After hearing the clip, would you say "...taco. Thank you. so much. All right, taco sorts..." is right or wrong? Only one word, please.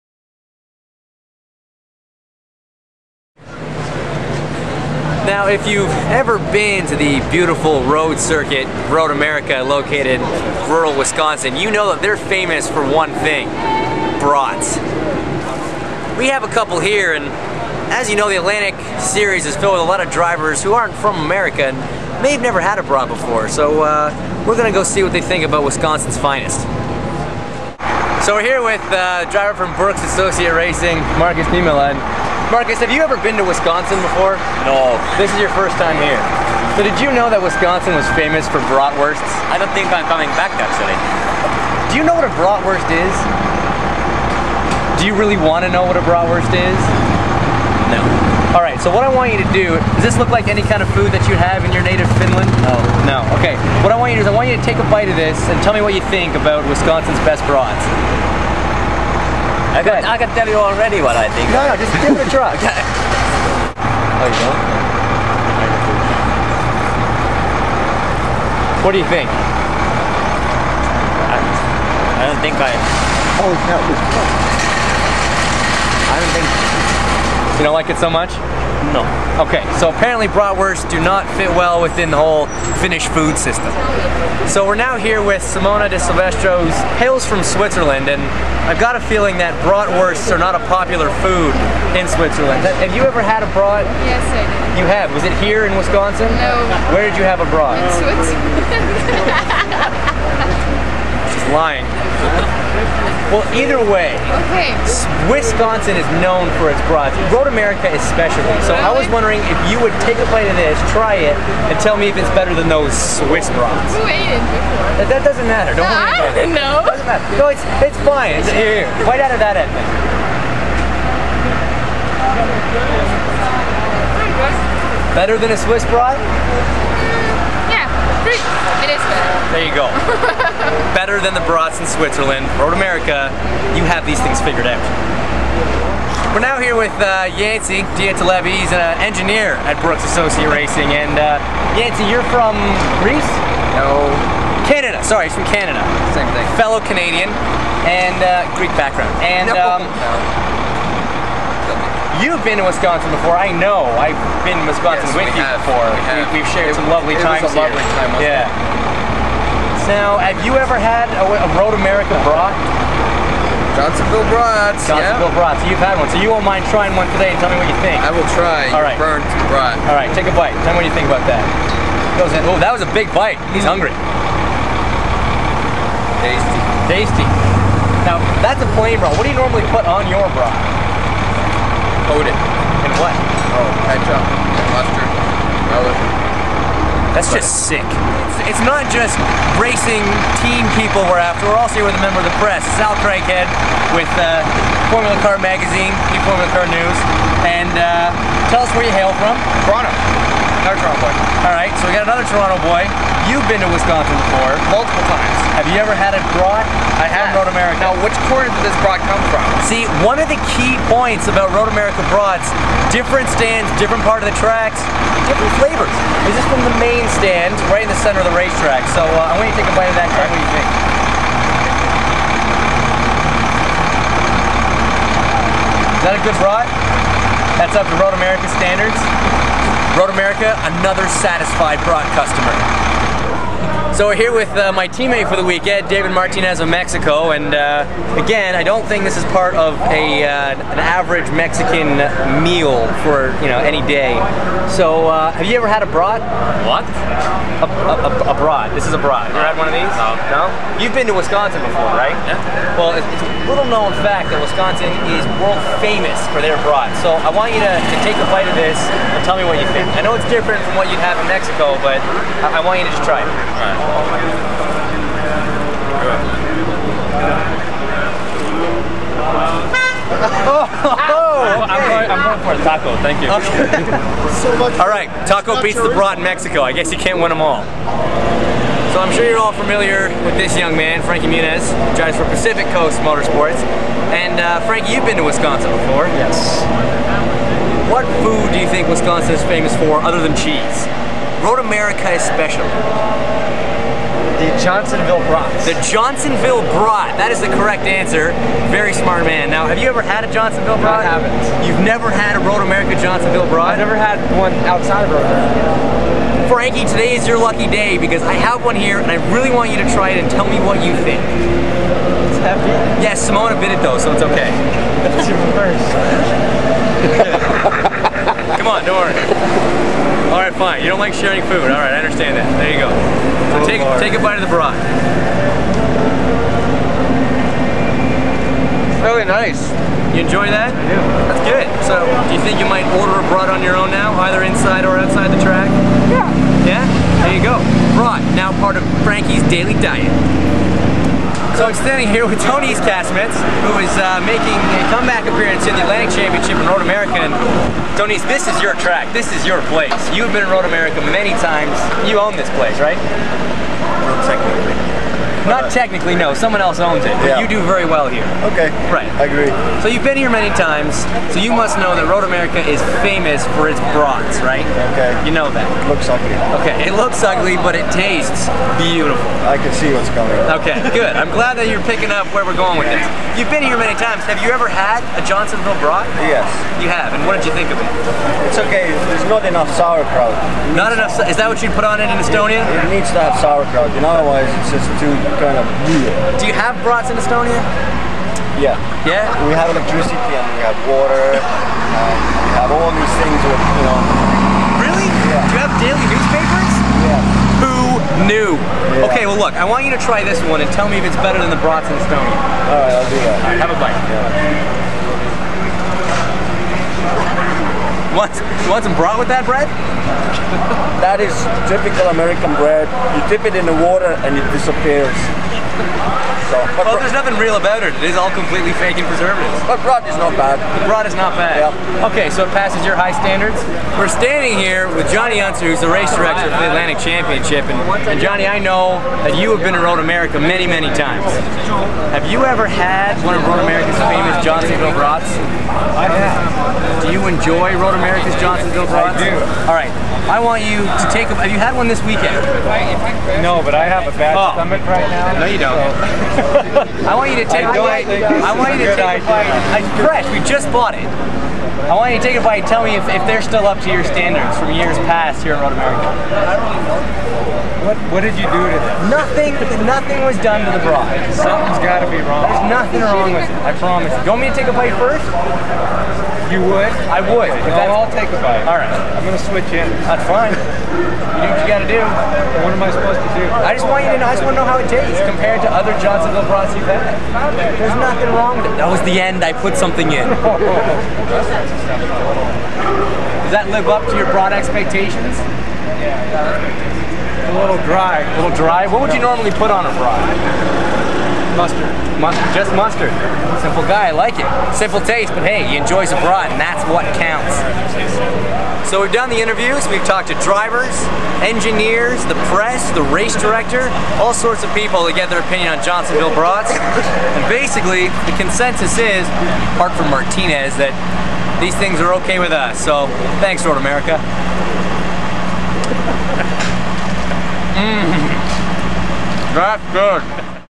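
wrong.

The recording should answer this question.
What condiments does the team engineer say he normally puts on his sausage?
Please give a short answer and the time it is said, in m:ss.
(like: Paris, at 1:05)
ketchup, mustard, relish, at 3:03.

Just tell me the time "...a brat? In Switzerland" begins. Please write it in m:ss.
1:37.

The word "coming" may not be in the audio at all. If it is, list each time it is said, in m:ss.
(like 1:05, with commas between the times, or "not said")
0:40, 6:10.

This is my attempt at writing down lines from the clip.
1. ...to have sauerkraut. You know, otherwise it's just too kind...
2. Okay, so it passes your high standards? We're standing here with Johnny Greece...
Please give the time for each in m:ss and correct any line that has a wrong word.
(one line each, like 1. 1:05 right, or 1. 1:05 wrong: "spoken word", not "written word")
1. 6:23 right
2. 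7:02 wrong: "Unser", not "Greece".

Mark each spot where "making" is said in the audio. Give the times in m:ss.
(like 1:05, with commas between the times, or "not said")
5:44.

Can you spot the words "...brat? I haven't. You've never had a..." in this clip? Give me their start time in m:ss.
5:00.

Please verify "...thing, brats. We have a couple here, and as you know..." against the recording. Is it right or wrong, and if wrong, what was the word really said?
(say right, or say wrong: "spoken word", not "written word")
right.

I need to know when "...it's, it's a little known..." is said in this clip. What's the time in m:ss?
4:12.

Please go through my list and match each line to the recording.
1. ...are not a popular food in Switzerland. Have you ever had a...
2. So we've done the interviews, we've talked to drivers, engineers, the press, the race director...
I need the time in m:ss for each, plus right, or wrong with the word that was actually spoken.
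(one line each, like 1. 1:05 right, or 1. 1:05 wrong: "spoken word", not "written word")
1. 1:30 right
2. 8:18 right.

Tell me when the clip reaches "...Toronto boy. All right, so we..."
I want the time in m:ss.
3:20.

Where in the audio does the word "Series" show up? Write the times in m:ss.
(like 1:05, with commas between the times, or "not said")
0:18.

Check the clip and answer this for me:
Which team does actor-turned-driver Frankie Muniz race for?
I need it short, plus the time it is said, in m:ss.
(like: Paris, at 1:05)
Pacific Coast Motorsports, at 4:42.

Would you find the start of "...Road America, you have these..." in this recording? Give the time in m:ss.
2:12.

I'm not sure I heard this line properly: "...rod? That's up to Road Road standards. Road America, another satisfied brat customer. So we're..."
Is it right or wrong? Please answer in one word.
wrong.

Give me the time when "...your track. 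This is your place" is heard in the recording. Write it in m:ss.
5:48.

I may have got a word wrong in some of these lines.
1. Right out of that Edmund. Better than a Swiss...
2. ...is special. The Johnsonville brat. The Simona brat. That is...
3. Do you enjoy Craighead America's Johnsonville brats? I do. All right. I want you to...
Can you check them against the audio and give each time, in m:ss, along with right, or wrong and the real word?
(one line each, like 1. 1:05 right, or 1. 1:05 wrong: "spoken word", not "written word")
1. 1:59 right
2. 4:52 wrong: "Johnsonville", not "Simona"
3. 7:17 wrong: "Road", not "Craighead".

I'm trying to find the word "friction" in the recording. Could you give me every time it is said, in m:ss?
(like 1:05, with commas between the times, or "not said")
not said.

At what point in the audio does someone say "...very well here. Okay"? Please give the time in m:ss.
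5:57.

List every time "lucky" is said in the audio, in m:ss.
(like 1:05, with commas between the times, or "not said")
5:07.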